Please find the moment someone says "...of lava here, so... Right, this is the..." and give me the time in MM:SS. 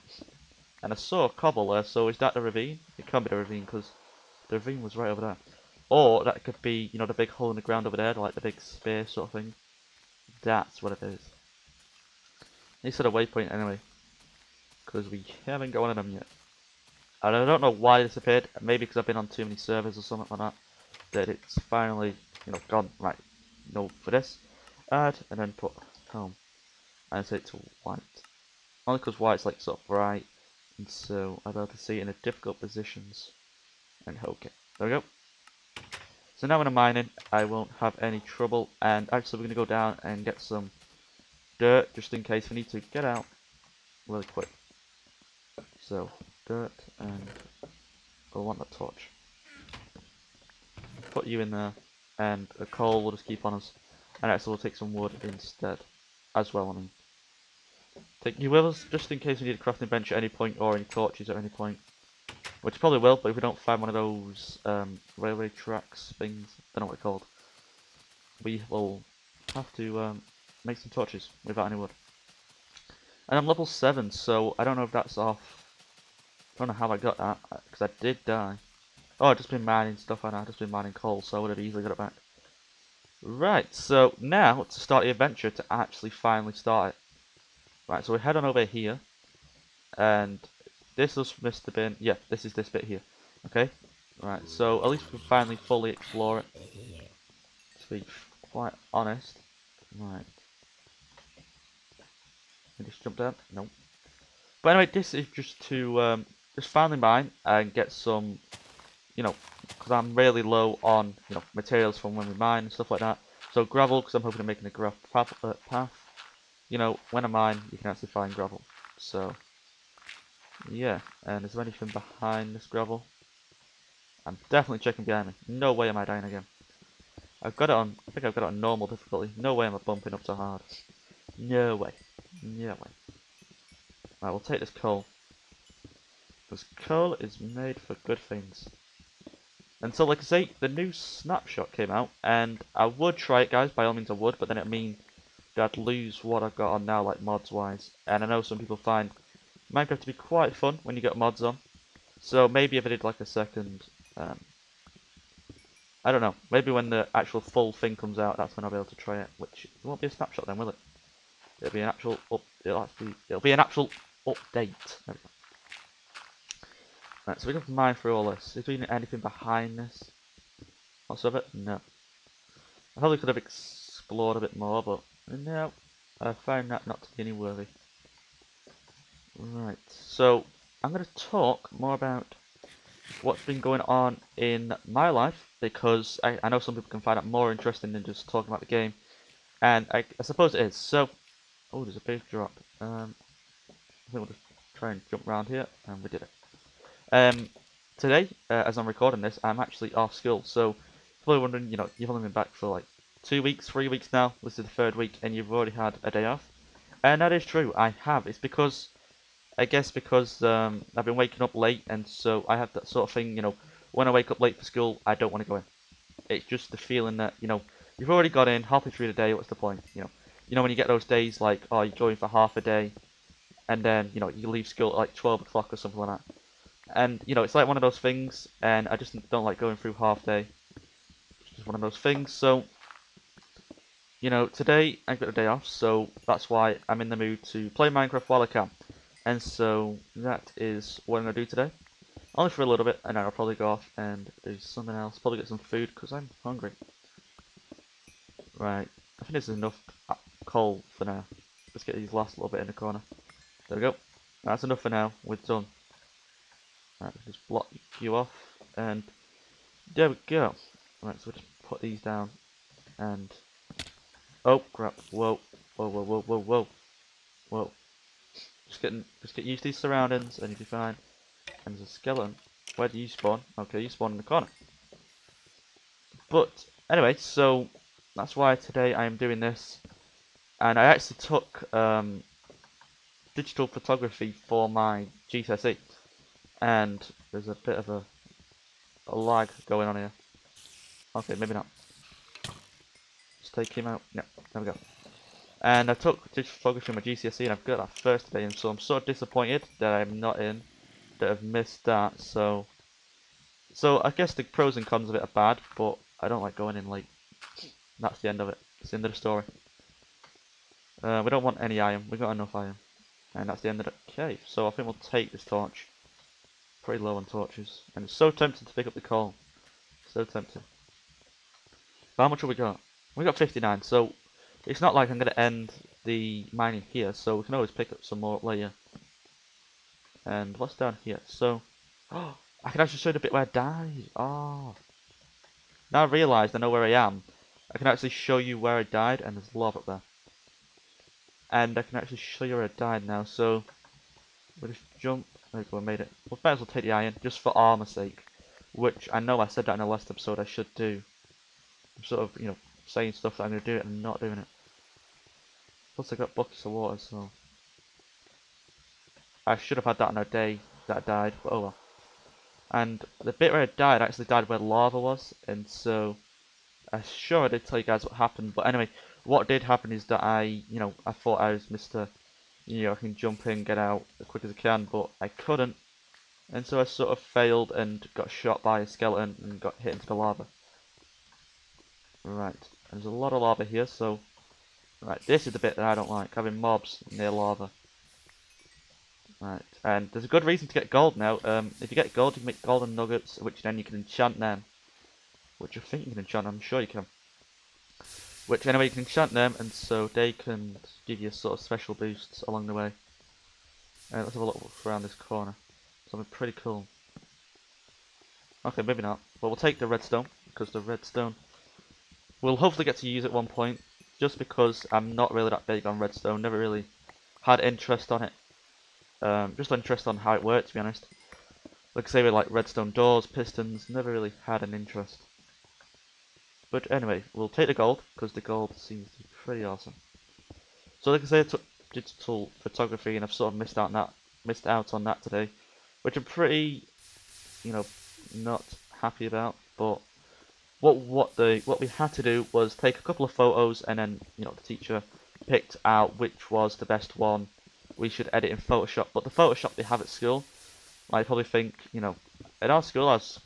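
06:23.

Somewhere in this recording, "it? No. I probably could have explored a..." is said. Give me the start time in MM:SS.
02:51.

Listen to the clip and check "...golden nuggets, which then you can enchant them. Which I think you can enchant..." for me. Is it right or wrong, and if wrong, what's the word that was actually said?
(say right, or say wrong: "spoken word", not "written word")
right.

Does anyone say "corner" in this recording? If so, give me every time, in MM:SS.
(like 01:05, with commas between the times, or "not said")
04:12, 04:34, 06:45.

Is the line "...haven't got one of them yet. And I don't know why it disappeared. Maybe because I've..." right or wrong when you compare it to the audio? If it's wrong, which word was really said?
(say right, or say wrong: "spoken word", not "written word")
right.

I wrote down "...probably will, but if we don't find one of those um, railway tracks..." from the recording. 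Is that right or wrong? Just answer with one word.
right.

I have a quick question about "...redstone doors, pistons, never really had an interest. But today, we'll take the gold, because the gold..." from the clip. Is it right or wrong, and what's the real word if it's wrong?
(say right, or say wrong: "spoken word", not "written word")
wrong: "anyway", not "today".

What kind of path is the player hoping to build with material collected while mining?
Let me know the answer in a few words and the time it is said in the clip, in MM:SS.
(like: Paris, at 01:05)
Gravel path, at 01:54.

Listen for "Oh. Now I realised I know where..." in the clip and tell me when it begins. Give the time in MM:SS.
05:34.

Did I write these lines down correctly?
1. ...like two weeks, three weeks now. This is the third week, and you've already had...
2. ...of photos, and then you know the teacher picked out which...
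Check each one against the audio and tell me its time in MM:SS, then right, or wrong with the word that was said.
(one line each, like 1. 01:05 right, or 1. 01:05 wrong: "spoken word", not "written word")
1. 03:22 right
2. 07:23 right.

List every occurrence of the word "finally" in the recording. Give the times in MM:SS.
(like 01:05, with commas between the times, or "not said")
00:21, 01:26, 01:35, 01:46.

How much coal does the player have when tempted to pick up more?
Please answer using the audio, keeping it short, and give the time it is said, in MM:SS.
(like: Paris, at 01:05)
59, at 05:23.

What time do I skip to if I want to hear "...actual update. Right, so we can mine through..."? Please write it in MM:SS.
02:43.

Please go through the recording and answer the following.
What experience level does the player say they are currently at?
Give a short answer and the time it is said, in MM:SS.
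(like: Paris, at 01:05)
7, at 01:13.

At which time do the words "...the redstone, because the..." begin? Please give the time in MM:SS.
06:49.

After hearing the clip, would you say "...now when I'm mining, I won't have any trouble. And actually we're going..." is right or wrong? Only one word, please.
right.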